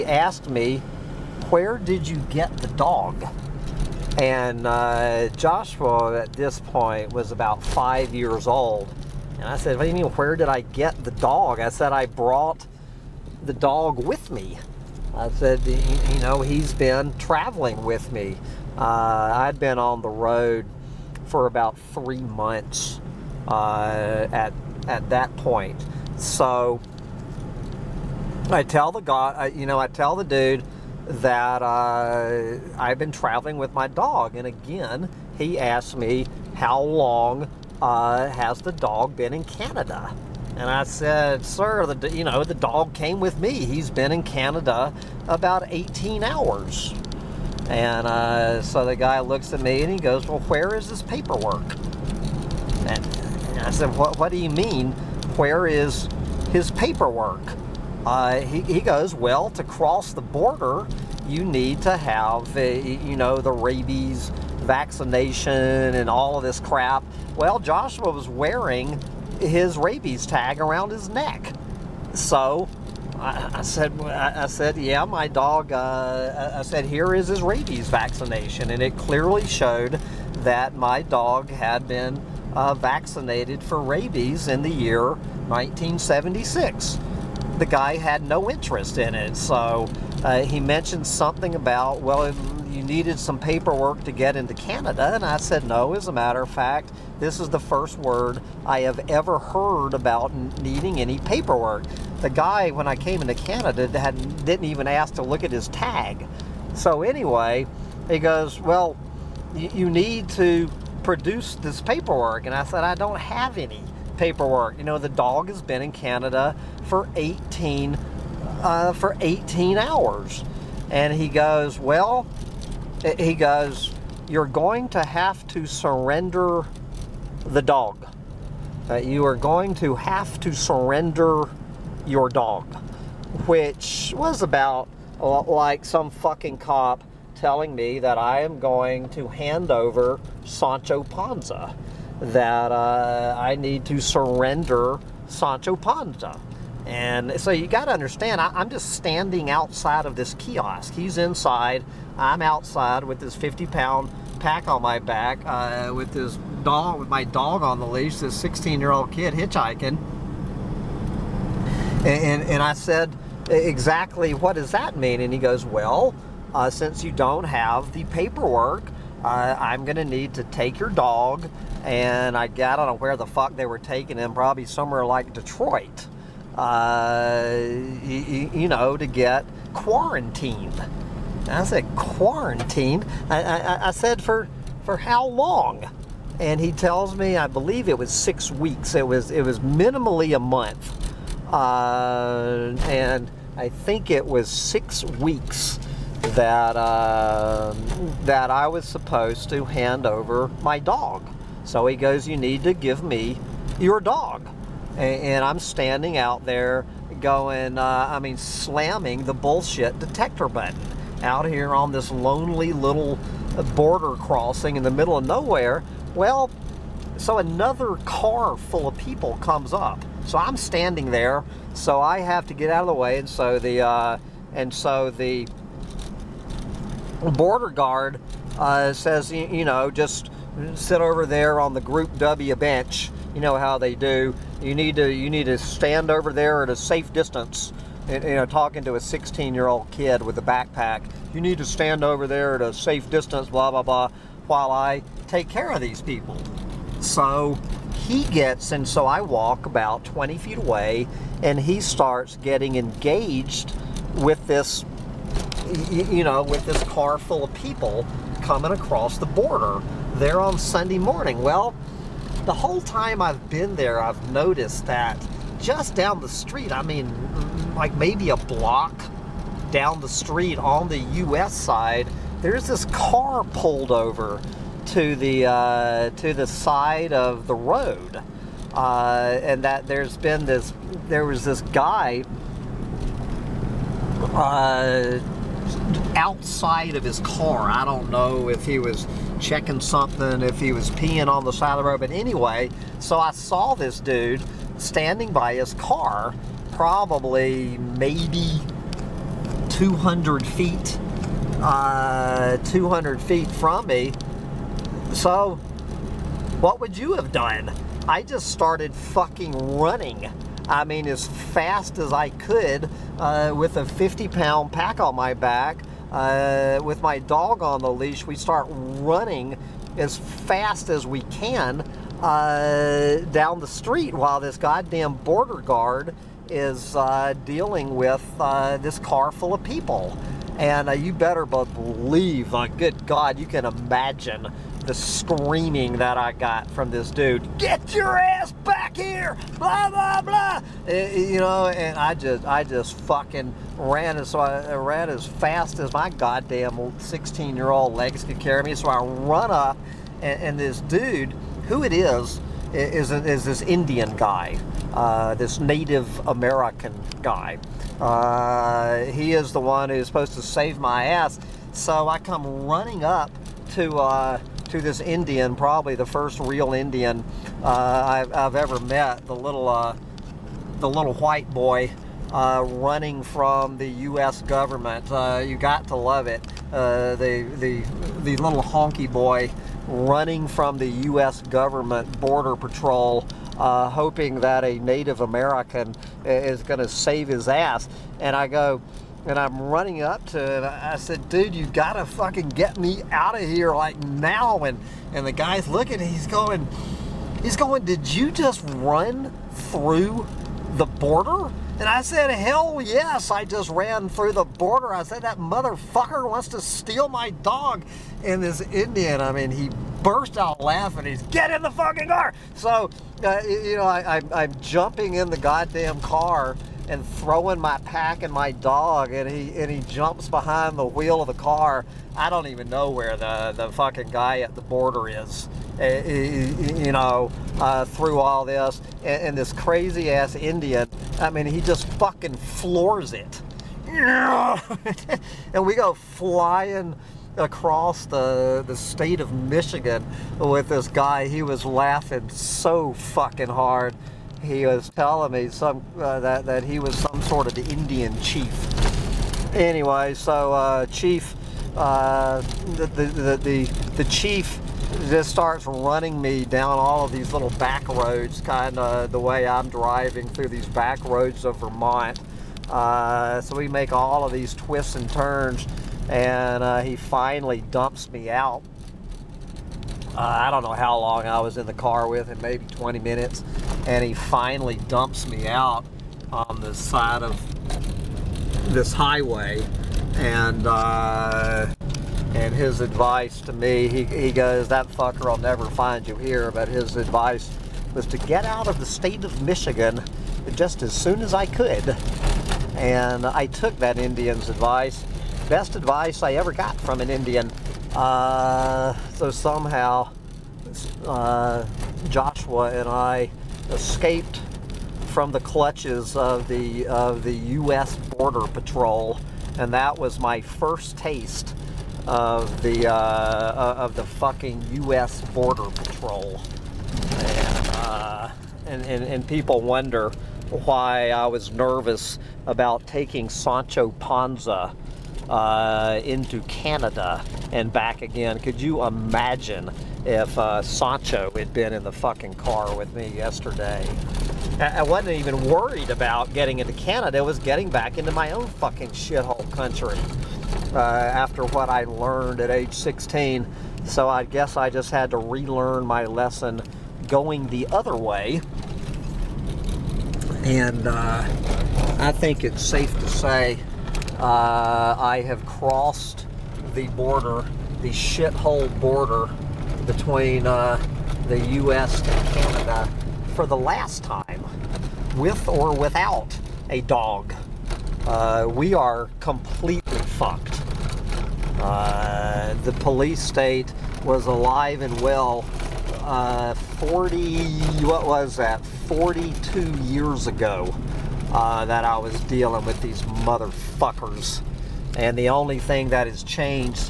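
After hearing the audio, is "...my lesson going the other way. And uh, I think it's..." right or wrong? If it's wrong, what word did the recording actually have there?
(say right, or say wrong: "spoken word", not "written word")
right.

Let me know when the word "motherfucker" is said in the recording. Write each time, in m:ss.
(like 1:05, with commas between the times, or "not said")
6:45, 9:43.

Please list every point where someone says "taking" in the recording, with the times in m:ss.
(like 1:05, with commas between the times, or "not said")
2:53, 8:42.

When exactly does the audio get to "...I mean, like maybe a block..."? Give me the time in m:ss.
4:26.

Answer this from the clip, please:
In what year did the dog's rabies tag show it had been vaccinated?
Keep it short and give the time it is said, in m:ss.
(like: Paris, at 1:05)
1976, at 1:25.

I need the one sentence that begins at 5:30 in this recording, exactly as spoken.
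And uh, you better believe, uh, good God, you can imagine the screaming that I got from this dude.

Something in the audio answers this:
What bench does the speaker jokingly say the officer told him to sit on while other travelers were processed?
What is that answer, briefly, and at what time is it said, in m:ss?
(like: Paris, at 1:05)
Group W bench, at 3:51.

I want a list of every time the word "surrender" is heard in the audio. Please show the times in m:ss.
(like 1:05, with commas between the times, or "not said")
2:05, 2:10, 2:23.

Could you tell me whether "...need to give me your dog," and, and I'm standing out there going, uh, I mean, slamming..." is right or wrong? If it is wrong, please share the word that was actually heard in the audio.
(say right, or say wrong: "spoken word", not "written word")
right.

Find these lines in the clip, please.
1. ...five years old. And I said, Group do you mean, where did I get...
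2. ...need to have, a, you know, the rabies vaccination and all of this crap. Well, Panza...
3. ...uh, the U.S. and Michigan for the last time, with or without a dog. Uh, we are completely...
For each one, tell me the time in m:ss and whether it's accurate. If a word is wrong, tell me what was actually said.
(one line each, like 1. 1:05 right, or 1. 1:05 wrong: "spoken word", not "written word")
1. 0:07 wrong: "What", not "Group"
2. 1:01 wrong: "Joshua", not "Panza"
3. 9:20 wrong: "Canada", not "Michigan".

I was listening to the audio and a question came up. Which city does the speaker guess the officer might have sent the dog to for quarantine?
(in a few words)
Detroit.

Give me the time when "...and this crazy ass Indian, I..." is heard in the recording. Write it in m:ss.
7:09.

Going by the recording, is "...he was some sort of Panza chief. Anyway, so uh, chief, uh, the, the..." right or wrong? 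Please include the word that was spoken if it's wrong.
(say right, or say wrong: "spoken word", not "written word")
wrong: "Indian", not "Panza".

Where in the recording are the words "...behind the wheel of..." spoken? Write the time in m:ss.
7:00.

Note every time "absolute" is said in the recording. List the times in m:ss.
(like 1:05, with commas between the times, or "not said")
not said.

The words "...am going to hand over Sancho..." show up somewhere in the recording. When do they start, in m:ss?
2:18.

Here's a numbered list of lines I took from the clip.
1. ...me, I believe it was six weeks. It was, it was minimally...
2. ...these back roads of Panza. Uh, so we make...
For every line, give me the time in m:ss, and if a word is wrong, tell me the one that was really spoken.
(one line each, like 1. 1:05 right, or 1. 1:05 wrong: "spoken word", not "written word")
1. 3:07 right
2. 7:40 wrong: "Vermont", not "Panza".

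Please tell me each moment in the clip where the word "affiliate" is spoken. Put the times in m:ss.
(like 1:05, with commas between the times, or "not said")
not said.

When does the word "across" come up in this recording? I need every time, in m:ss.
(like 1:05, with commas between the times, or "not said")
4:18, 7:17.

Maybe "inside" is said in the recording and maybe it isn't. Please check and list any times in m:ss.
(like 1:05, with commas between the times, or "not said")
2:31.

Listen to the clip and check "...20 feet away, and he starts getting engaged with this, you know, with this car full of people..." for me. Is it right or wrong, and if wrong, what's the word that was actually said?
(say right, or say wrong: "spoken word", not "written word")
right.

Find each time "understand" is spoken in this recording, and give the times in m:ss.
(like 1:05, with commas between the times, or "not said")
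2:27.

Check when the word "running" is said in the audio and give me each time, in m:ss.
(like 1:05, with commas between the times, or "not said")
5:09, 5:18, 6:02, 6:12, 6:19, 6:29, 7:35.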